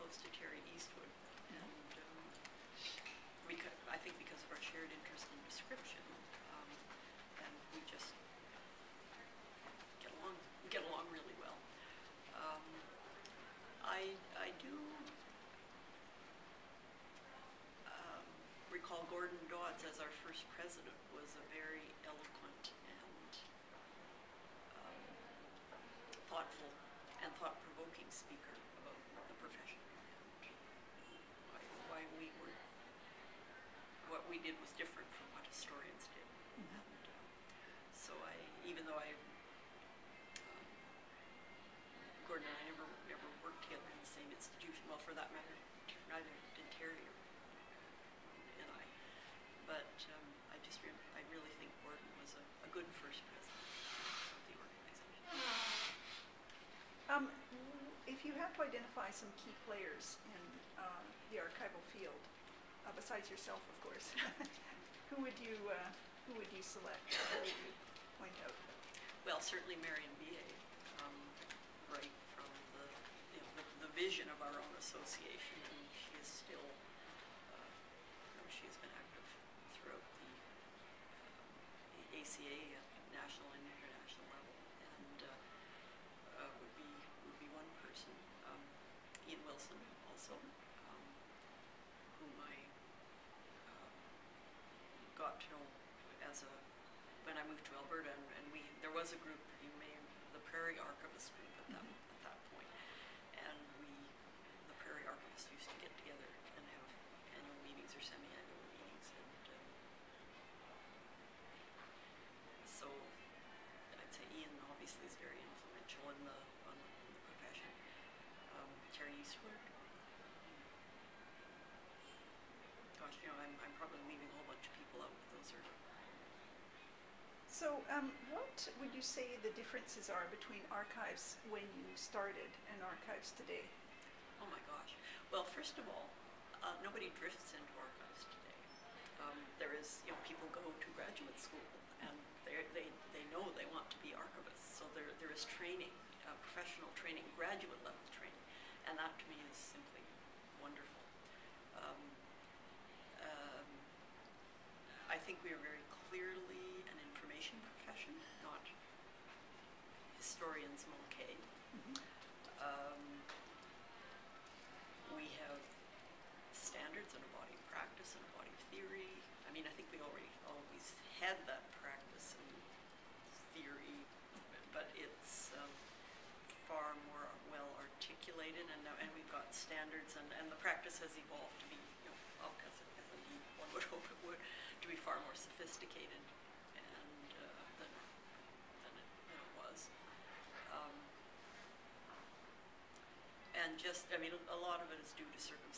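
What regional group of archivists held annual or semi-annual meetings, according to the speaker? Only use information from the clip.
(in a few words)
Prairie Archivist group.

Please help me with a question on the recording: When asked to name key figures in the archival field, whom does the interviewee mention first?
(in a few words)
Marion Beyea.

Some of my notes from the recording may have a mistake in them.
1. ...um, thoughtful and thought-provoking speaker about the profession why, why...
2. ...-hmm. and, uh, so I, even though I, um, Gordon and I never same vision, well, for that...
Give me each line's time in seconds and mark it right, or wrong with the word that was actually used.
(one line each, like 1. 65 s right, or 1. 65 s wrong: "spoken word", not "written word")
1. 24 s right
2. 36 s wrong: "institution", not "vision".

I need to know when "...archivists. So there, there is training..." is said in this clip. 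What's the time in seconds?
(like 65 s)
144 s.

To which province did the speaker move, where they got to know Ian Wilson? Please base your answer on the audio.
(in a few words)
Alberta.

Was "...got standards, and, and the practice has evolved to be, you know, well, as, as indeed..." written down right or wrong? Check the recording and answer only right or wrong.
right.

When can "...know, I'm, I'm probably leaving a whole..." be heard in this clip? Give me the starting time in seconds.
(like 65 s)
123 s.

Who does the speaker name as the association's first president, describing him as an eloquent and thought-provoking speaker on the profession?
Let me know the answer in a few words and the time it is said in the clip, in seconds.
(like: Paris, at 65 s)
Gordon Dodds, at 19 s.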